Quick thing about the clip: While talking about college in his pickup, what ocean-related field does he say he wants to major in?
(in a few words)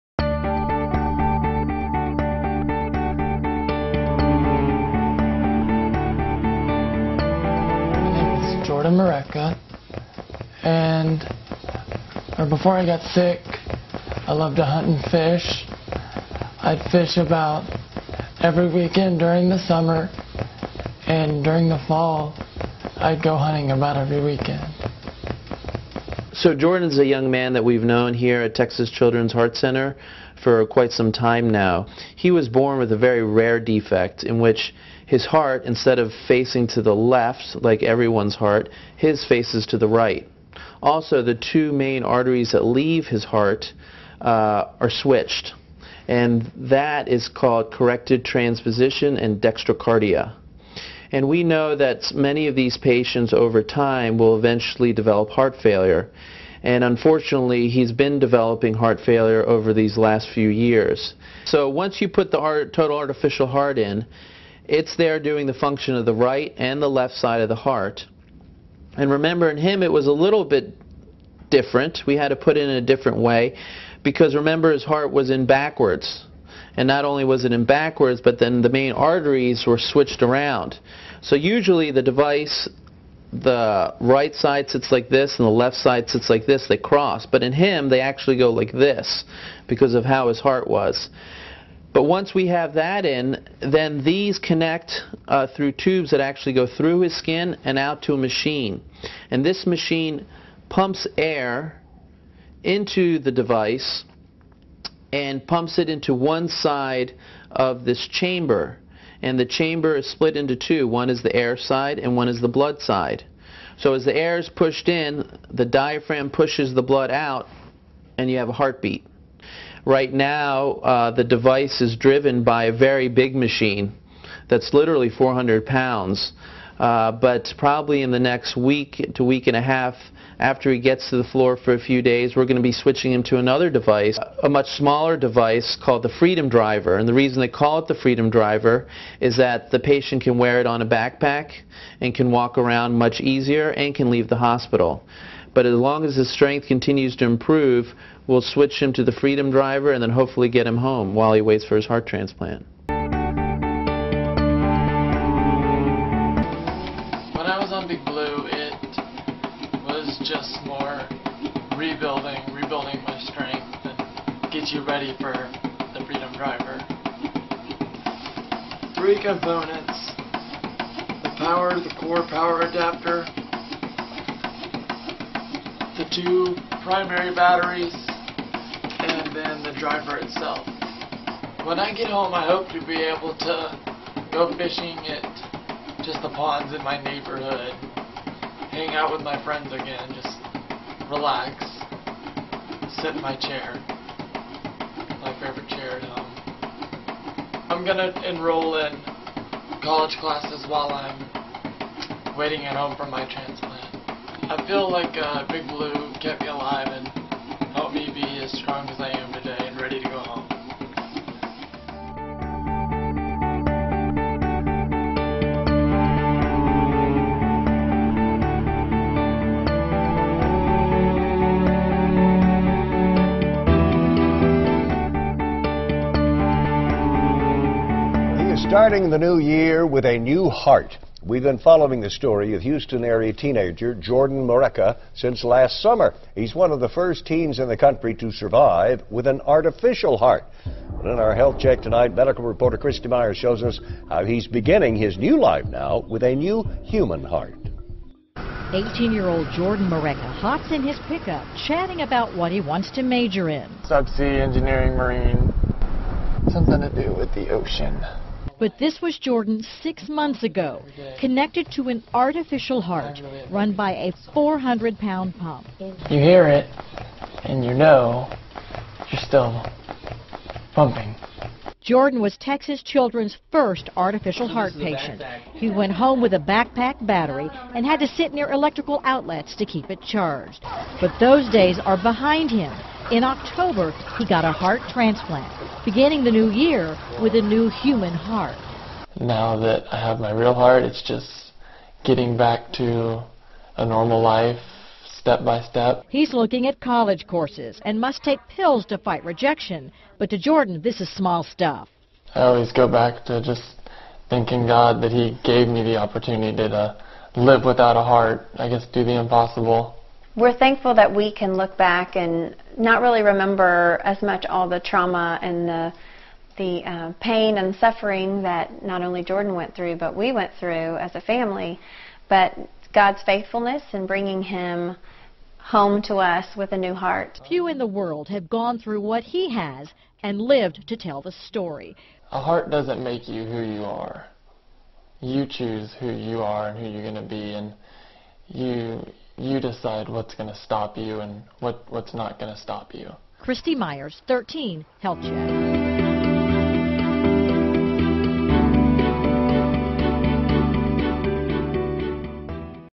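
Subsea engineering.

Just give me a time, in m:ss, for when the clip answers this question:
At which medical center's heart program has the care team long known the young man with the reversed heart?
0:28.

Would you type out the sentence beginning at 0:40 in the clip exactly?
Also, the two main arteries that leave his heart uh, are switched, and that is called corrected transposition and dextrocardia.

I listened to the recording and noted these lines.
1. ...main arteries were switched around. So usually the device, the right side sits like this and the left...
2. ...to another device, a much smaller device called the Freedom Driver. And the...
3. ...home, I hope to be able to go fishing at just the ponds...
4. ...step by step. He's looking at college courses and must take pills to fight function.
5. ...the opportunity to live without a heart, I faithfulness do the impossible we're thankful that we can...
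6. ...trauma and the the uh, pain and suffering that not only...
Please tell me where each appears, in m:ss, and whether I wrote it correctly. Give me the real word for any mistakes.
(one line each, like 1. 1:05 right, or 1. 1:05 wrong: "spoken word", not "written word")
1. 1:18 right
2. 2:13 right
3. 3:02 right
4. 4:55 wrong: "rejection", not "function"
5. 5:05 wrong: "guess", not "faithfulness"
6. 5:14 right.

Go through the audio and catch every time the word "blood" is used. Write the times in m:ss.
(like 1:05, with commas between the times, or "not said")
1:52, 1:56.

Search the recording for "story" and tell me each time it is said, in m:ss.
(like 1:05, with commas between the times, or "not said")
3:52, 5:31.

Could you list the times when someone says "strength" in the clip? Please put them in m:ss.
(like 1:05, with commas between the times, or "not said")
2:26, 2:43.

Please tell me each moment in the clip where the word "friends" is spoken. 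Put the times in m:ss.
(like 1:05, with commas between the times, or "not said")
3:09.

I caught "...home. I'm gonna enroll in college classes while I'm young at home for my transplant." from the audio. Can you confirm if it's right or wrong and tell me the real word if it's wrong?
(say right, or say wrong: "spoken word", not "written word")
wrong: "waiting", not "young".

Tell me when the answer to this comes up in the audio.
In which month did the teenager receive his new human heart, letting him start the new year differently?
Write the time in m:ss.
4:43.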